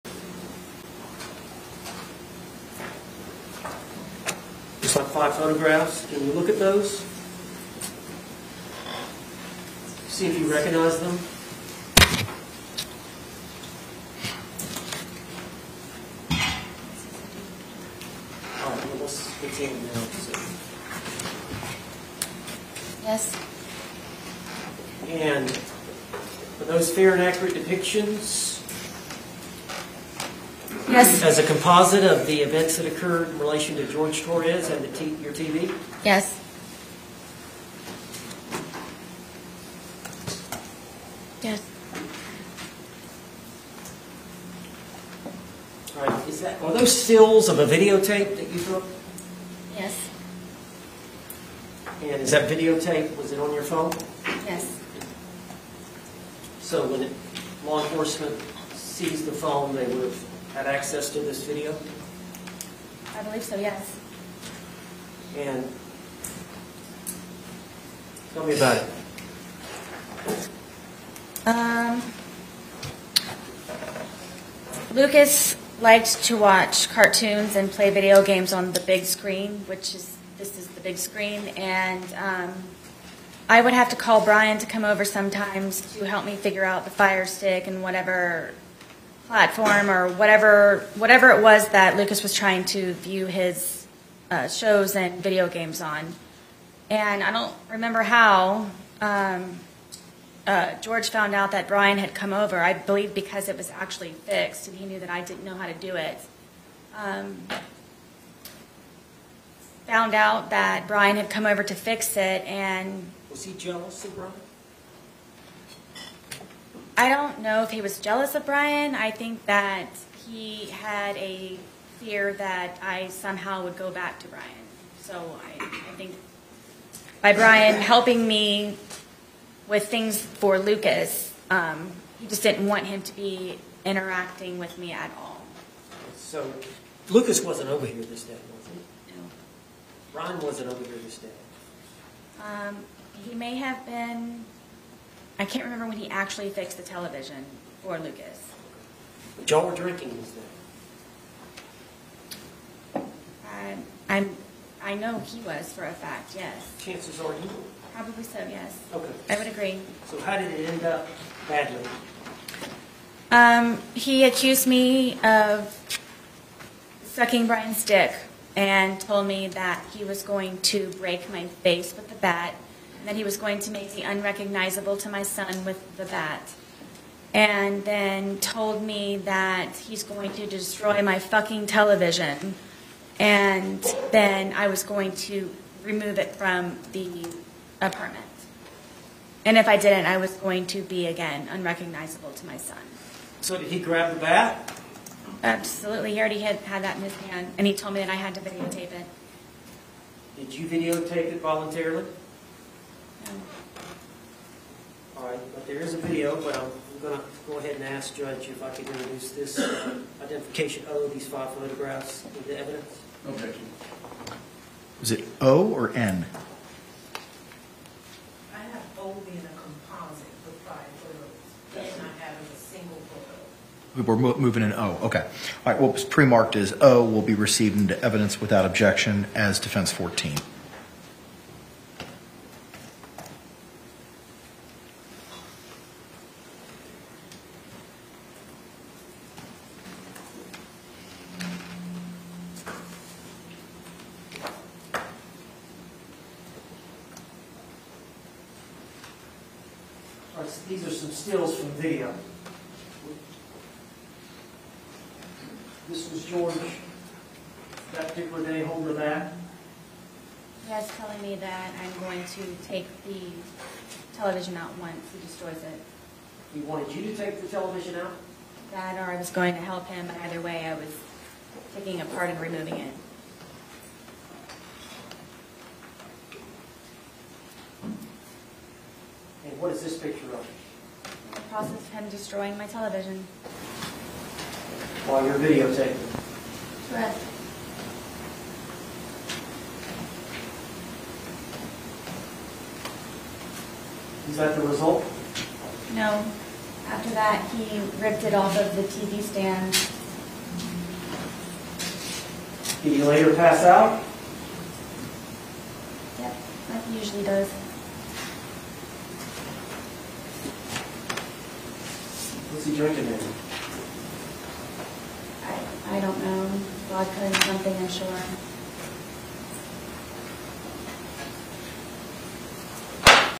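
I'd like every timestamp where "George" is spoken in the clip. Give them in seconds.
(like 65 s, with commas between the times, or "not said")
33 s, 100 s, 256 s.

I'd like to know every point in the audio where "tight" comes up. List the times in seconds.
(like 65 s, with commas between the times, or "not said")
not said.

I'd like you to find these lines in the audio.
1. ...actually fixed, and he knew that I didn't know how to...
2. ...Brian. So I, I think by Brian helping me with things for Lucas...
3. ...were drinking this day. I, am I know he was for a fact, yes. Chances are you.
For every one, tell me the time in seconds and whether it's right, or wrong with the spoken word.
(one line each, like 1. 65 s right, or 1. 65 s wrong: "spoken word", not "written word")
1. 103 s right
2. 124 s right
3. 149 s right.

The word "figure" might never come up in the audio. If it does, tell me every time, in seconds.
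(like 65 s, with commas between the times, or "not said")
86 s.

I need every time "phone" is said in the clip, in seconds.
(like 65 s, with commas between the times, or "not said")
53 s, 59 s.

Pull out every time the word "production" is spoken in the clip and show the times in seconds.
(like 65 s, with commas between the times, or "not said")
not said.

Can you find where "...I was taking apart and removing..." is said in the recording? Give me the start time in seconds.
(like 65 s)
270 s.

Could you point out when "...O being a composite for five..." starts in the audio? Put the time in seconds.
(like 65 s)
218 s.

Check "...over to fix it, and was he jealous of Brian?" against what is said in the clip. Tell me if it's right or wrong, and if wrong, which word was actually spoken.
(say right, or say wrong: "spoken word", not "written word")
right.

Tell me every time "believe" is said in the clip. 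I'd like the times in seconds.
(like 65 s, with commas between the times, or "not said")
63 s, 102 s.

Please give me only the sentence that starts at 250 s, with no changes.
these are some stills from video.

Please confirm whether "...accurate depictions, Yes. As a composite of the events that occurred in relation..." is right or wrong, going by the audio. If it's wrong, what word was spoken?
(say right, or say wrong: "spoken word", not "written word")
right.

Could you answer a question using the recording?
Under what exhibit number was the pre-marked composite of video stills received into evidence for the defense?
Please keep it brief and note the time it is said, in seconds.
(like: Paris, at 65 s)
Defense 14, at 229 s.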